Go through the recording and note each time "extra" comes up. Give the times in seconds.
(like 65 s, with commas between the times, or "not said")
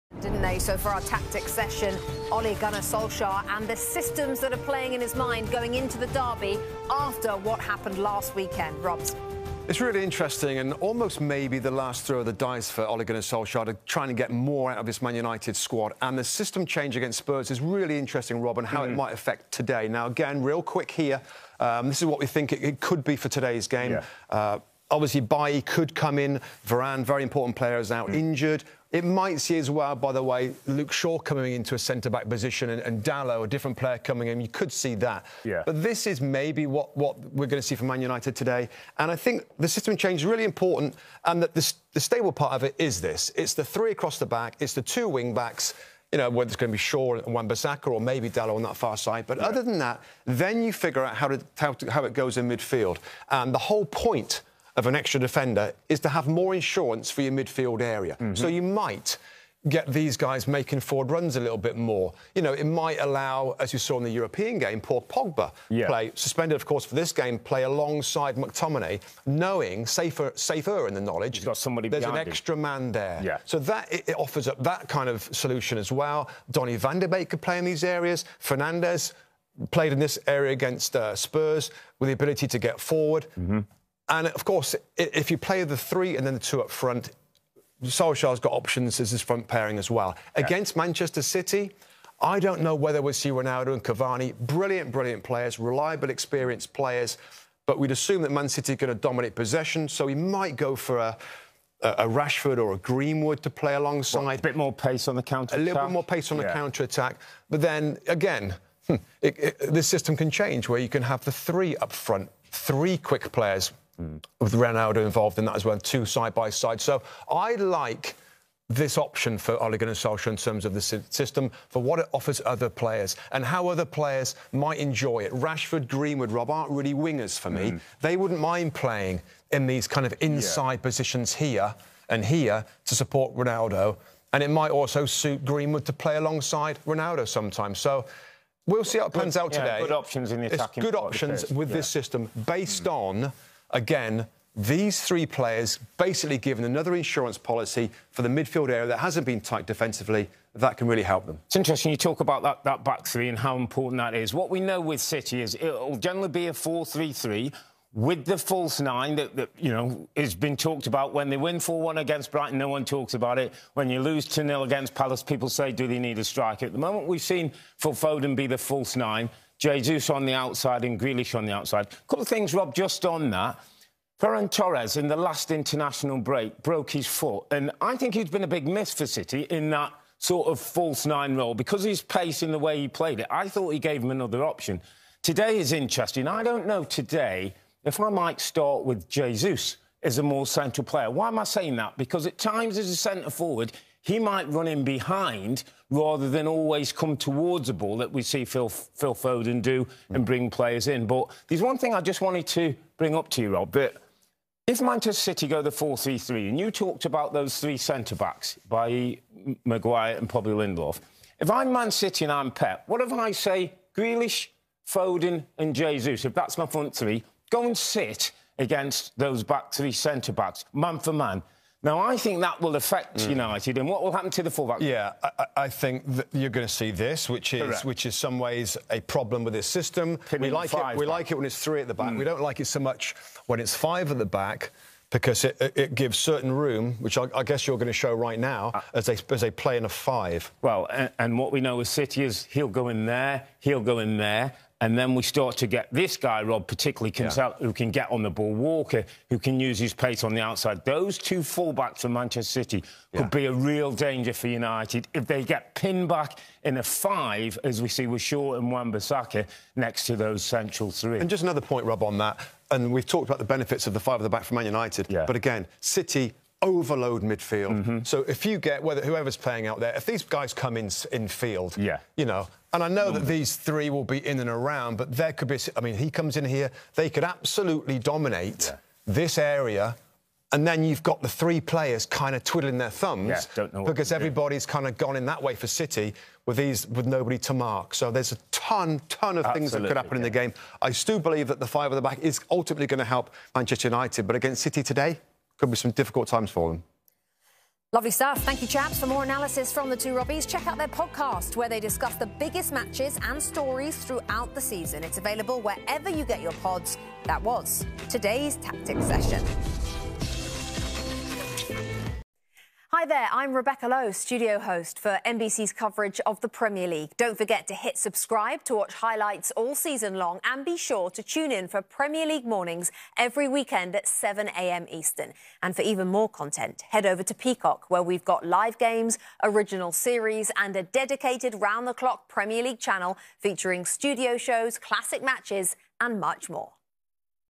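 54 s, 72 s.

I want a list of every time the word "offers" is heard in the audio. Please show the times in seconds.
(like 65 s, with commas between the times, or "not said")
74 s, 122 s.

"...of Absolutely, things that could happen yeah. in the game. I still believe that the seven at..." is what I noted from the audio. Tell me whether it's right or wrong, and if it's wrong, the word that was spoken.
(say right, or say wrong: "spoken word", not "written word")
wrong: "five", not "seven".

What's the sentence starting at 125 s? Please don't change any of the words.
Rashford, Greenwood, Rob aren't really wingers for me.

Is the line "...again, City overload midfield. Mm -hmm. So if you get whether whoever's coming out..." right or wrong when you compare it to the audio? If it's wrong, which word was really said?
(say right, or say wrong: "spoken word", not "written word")
wrong: "playing", not "coming".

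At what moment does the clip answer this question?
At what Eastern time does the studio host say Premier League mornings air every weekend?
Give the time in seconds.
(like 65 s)
324 s.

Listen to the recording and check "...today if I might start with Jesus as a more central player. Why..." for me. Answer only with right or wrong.
right.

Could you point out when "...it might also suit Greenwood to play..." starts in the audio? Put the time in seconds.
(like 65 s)
134 s.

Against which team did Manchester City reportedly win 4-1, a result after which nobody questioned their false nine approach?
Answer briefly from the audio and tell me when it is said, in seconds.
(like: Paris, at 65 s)
Brighton, at 162 s.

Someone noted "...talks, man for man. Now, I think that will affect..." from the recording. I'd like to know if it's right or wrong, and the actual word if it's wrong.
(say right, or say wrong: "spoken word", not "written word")
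wrong: "backs", not "talks".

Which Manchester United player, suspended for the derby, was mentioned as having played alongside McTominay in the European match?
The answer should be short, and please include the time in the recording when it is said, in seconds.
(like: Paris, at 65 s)
Paul Pogba, at 64 s.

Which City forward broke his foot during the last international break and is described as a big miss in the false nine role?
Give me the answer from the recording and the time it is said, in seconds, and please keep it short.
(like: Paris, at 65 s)
Ferran Torres, at 174 s.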